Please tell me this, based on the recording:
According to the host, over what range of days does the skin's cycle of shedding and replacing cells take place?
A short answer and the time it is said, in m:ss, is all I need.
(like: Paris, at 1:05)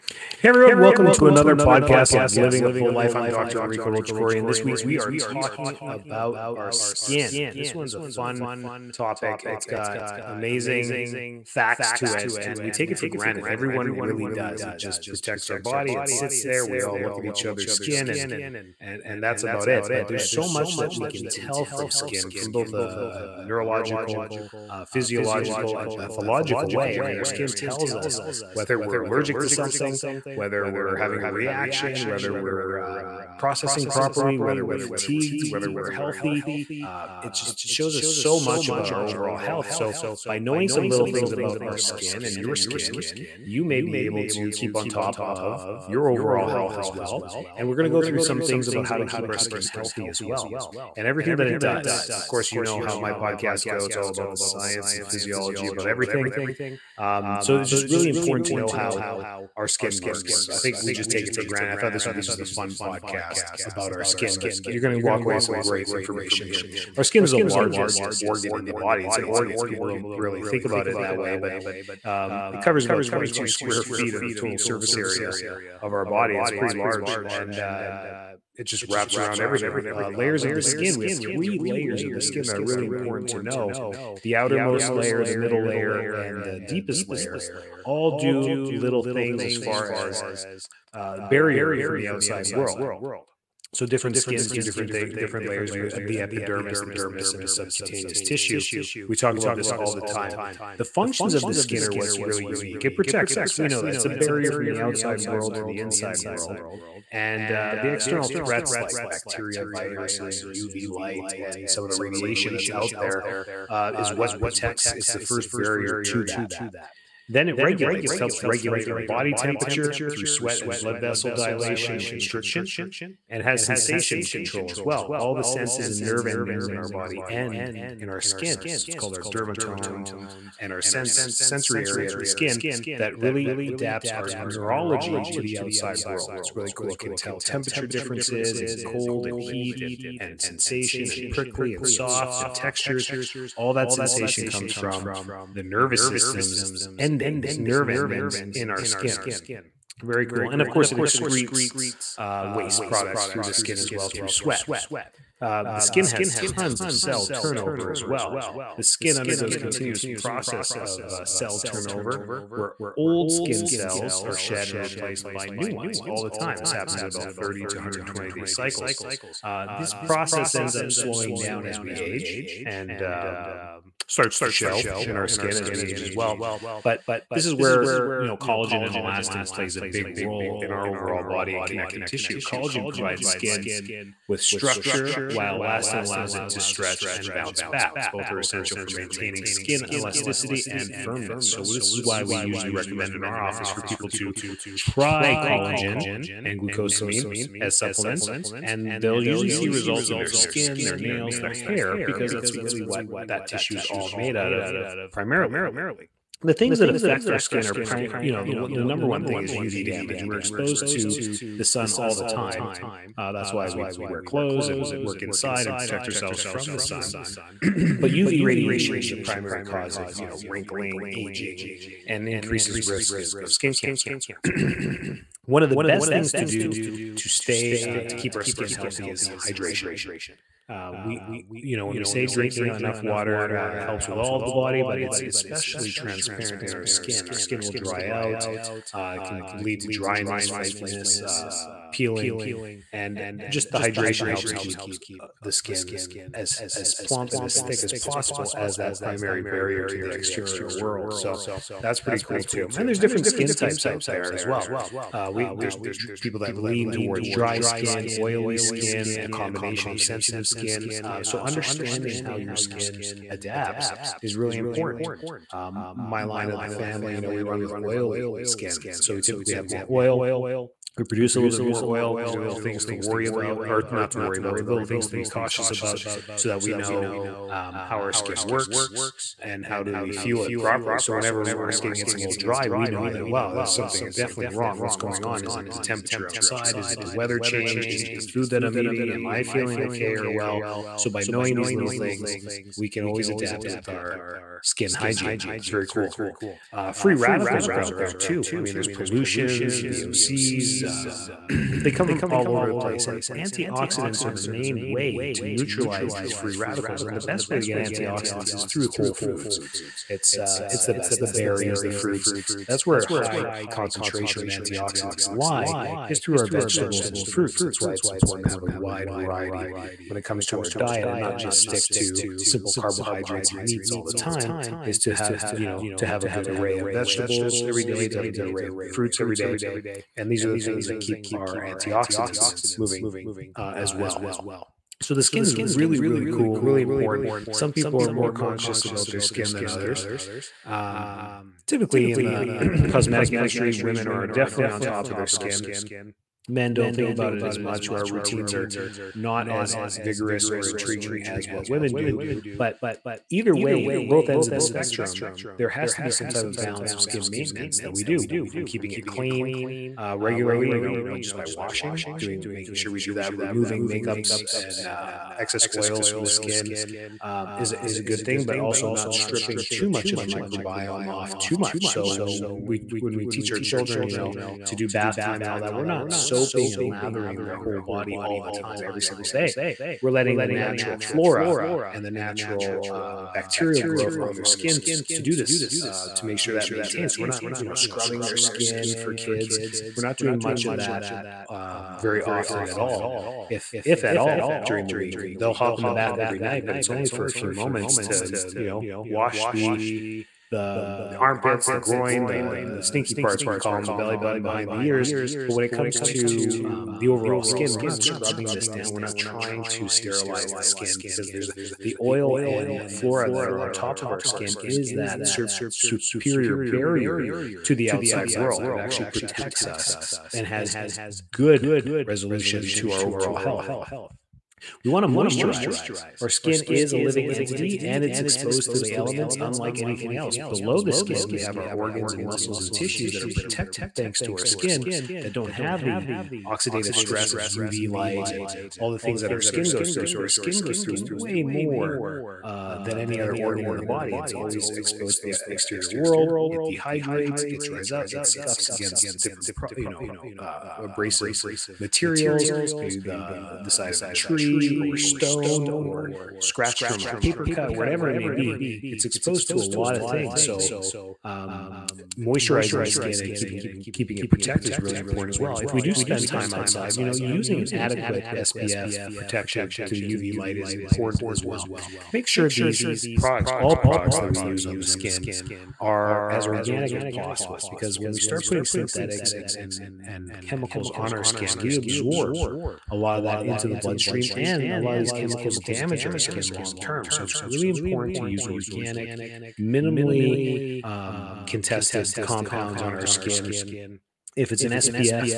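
30 to 120 days, at 2:47.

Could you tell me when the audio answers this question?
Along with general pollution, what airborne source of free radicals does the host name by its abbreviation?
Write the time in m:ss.
4:59.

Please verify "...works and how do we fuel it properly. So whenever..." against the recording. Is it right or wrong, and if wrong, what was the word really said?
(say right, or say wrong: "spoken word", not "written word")
right.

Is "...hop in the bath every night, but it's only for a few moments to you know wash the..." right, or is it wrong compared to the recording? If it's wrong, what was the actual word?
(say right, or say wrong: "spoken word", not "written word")
right.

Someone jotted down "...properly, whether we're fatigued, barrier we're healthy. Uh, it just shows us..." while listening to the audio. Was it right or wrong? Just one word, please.
wrong.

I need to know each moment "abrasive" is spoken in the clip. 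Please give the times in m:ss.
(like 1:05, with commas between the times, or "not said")
7:30.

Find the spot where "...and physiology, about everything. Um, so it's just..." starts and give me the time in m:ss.
0:54.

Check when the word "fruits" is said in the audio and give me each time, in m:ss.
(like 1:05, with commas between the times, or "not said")
5:11, 5:17, 5:28.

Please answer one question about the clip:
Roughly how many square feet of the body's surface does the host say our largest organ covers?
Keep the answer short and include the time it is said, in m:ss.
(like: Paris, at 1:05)
22, at 1:13.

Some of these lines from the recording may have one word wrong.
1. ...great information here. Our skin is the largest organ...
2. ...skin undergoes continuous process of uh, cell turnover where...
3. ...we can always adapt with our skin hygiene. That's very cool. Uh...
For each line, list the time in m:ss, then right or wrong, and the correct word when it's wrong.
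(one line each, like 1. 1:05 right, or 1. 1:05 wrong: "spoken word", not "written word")
1. 1:05 right
2. 2:38 right
3. 4:52 right.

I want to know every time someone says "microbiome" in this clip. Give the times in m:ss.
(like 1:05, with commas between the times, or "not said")
6:10.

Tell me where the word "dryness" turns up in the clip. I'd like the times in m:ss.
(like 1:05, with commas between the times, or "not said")
3:59.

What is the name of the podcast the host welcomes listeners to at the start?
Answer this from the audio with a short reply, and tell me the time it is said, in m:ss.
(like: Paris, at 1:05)
Living a Full Life, at 0:02.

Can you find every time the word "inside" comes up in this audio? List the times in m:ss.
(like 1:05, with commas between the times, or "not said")
1:45, 3:35.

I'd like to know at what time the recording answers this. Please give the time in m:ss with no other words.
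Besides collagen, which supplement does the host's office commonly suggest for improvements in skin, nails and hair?
3:16.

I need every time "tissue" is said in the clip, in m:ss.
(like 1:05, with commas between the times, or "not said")
1:38, 3:02, 3:23, 7:12.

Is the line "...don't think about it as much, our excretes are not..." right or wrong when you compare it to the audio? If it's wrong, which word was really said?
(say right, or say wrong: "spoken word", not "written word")
wrong: "routines", not "excretes".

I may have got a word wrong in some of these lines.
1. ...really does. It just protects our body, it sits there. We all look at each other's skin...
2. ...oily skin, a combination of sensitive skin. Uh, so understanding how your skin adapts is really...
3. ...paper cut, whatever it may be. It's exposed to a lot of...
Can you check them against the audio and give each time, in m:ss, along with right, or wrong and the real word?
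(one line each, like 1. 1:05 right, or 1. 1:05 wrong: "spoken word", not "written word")
1. 0:13 right
2. 4:18 right
3. 7:37 right.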